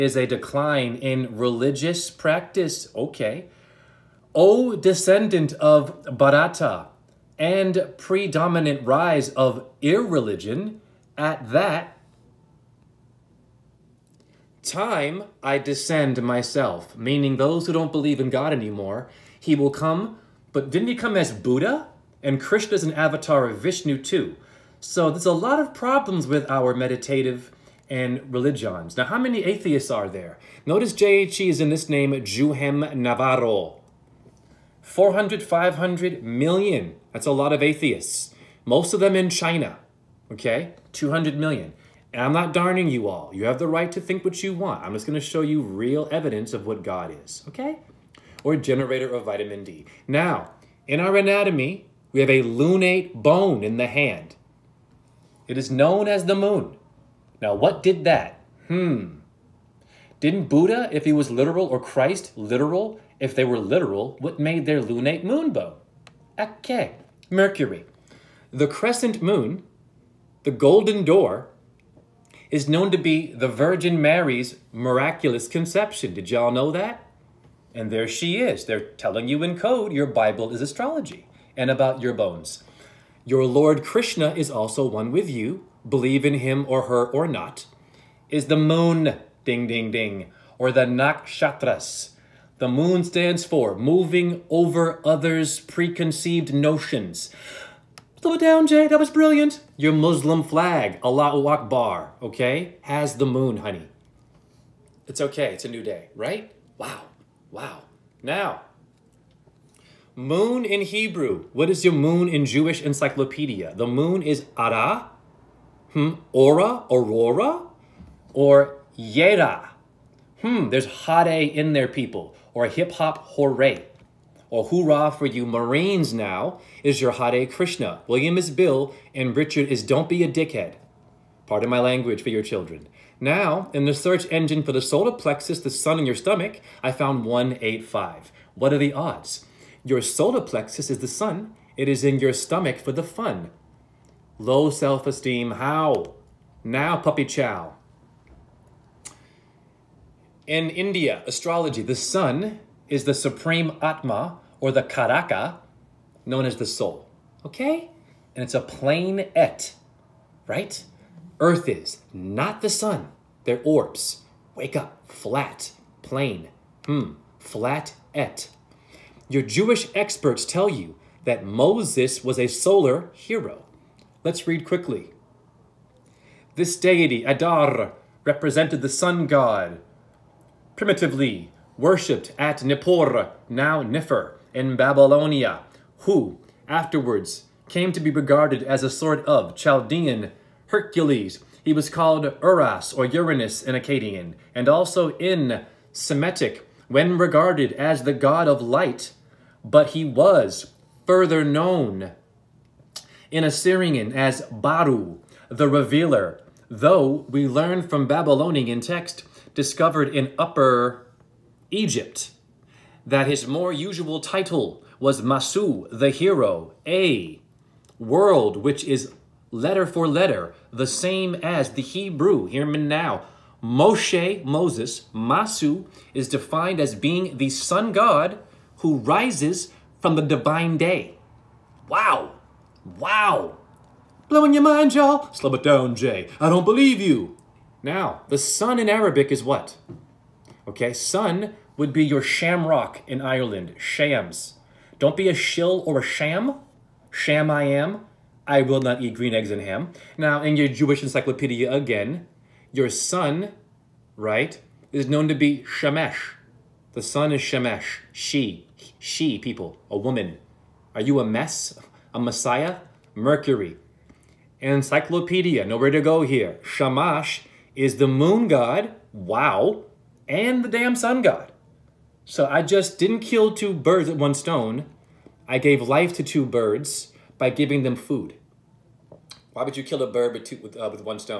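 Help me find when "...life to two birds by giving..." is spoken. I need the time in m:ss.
4:35.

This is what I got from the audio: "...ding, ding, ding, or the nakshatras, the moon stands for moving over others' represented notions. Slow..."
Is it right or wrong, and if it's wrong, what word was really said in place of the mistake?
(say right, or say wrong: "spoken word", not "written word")
wrong: "preconceived", not "represented".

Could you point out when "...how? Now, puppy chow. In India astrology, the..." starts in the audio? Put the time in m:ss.
2:25.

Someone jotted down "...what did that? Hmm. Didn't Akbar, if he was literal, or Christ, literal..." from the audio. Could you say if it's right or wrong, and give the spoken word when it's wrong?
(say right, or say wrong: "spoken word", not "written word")
wrong: "Buddha", not "Akbar".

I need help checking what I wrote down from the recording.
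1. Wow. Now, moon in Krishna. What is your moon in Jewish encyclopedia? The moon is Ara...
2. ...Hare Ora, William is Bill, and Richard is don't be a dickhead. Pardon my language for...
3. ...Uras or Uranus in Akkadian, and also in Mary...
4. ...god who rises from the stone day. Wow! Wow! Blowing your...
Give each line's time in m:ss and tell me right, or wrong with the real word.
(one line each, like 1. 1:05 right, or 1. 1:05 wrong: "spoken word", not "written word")
1. 1:47 wrong: "Hebrew", not "Krishna"
2. 2:07 wrong: "Krishna", not "Ora"
3. 3:12 wrong: "Semitic", not "Mary"
4. 3:47 wrong: "divine", not "stone".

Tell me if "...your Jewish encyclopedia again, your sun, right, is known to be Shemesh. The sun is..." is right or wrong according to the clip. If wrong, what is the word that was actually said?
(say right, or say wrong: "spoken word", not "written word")
right.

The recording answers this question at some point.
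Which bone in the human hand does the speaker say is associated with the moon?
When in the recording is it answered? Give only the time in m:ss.
0:52.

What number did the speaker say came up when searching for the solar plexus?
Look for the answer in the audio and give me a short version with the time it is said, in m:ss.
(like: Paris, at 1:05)
185, at 2:17.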